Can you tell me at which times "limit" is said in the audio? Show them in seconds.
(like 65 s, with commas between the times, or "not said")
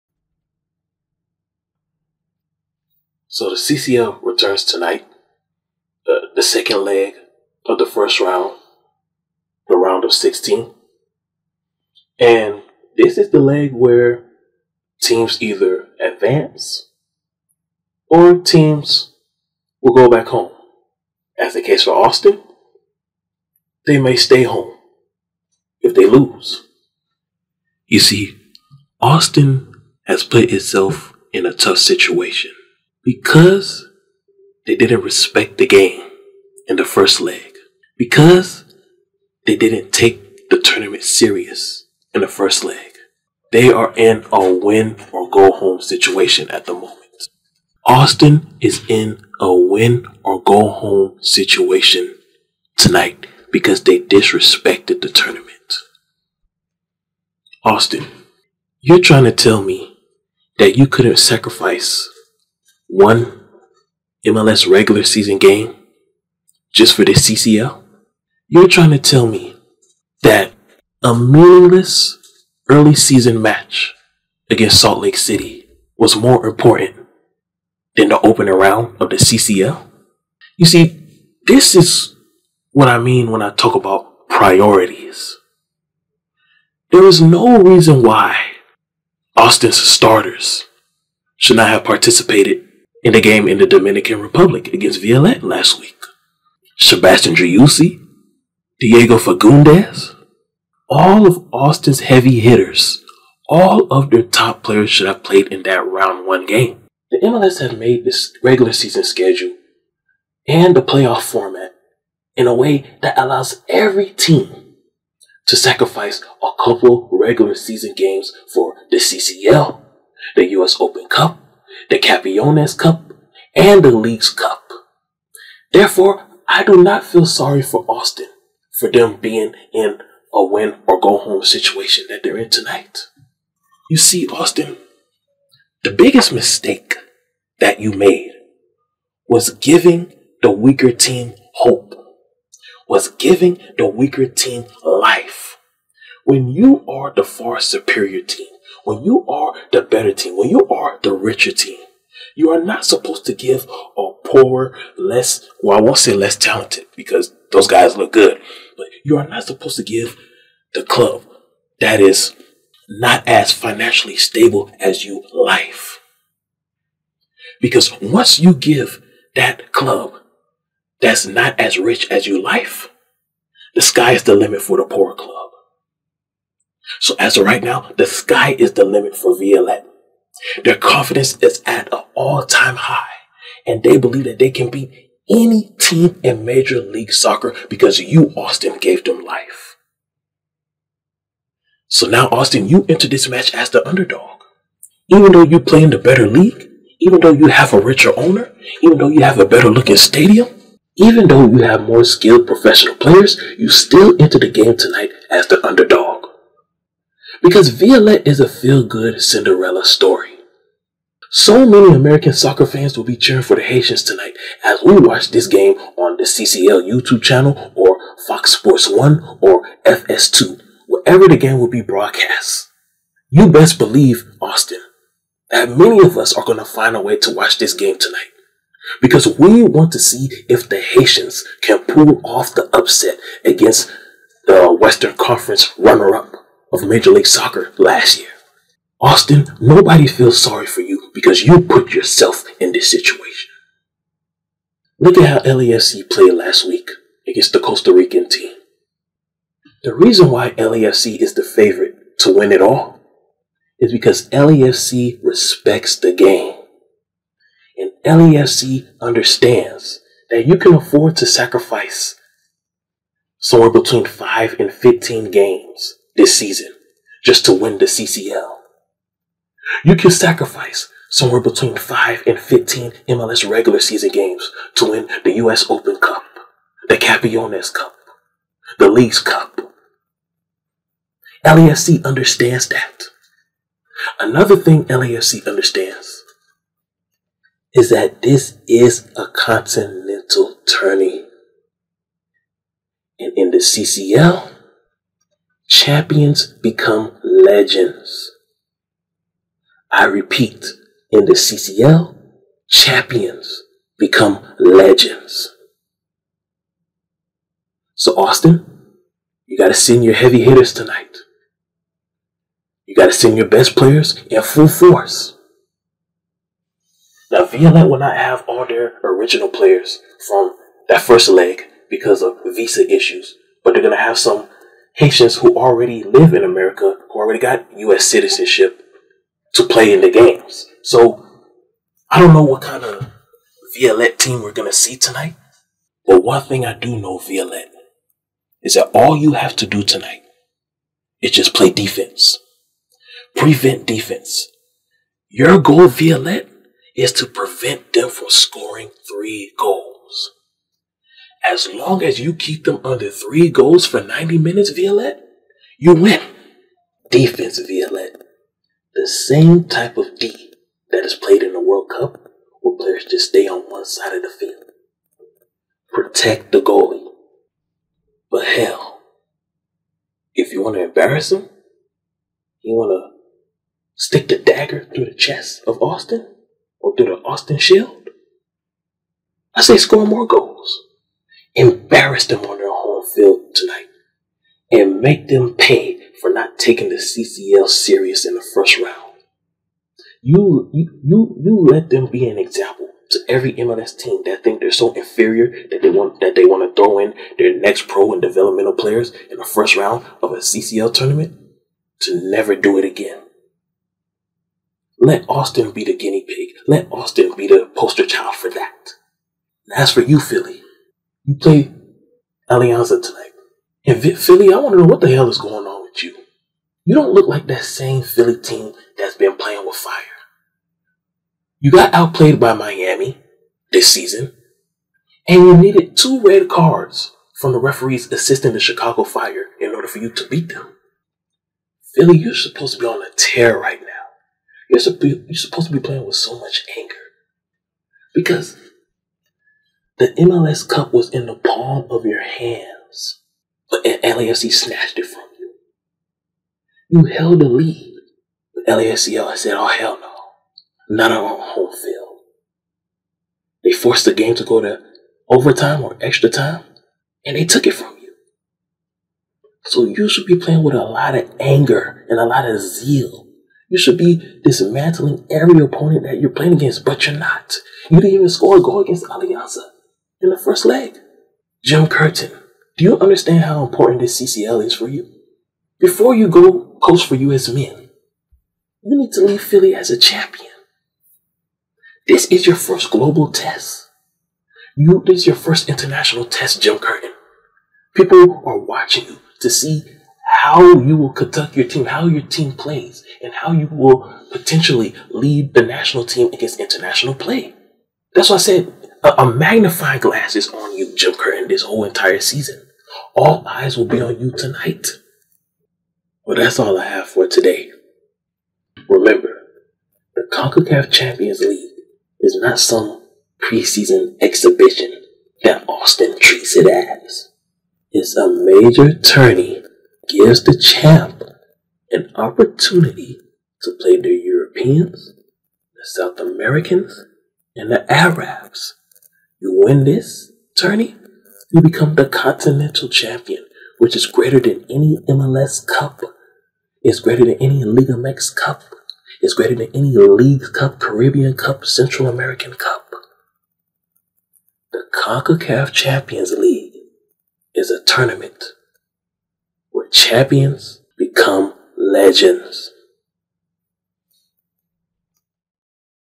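174 s, 178 s.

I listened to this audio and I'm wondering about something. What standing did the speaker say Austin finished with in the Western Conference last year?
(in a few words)
runner up.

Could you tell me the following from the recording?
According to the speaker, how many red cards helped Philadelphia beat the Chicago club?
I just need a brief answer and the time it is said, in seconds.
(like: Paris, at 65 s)
2, at 425 s.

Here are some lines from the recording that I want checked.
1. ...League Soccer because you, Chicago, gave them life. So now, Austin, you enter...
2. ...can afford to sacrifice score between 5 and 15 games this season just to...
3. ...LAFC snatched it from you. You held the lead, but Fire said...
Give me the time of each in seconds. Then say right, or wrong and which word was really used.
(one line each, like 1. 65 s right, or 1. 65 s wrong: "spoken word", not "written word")
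1. 186 s wrong: "Austin", not "Chicago"
2. 260 s wrong: "somewhere", not "score"
3. 443 s wrong: "LAFC", not "Fire".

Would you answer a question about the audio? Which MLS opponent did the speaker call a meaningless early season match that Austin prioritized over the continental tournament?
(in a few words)
Salt Lake City.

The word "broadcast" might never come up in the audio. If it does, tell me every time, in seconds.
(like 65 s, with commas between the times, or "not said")
221 s.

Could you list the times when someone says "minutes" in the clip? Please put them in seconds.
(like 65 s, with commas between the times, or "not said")
354 s.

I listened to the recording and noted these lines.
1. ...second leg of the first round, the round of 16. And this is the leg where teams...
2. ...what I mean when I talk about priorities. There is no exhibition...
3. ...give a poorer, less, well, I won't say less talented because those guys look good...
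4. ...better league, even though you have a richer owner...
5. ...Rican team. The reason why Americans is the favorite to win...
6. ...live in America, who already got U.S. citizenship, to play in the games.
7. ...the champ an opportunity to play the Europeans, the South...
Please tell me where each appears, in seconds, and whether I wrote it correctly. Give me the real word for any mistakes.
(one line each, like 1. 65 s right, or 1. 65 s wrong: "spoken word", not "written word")
1. 6 s right
2. 82 s wrong: "reason", not "exhibition"
3. 153 s right
4. 195 s right
5. 247 s wrong: "LAFC", not "Americans"
6. 326 s right
7. 520 s right.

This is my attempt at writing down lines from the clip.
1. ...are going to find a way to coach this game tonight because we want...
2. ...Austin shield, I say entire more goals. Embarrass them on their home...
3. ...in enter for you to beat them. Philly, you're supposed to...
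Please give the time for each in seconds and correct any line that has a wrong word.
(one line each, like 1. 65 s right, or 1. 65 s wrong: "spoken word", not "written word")
1. 226 s wrong: "watch", not "coach"
2. 377 s wrong: "score", not "entire"
3. 429 s wrong: "order", not "enter".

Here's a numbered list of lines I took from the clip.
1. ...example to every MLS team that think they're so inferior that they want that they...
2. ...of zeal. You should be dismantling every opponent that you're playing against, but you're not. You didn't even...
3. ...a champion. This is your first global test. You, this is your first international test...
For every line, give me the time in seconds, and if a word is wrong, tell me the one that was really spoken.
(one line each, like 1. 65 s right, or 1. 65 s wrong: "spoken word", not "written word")
1. 392 s right
2. 462 s right
3. 479 s right.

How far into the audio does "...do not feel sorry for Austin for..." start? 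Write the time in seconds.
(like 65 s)
126 s.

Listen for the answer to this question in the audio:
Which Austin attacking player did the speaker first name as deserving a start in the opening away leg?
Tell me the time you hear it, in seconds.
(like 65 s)
96 s.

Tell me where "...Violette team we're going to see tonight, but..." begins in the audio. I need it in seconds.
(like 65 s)
333 s.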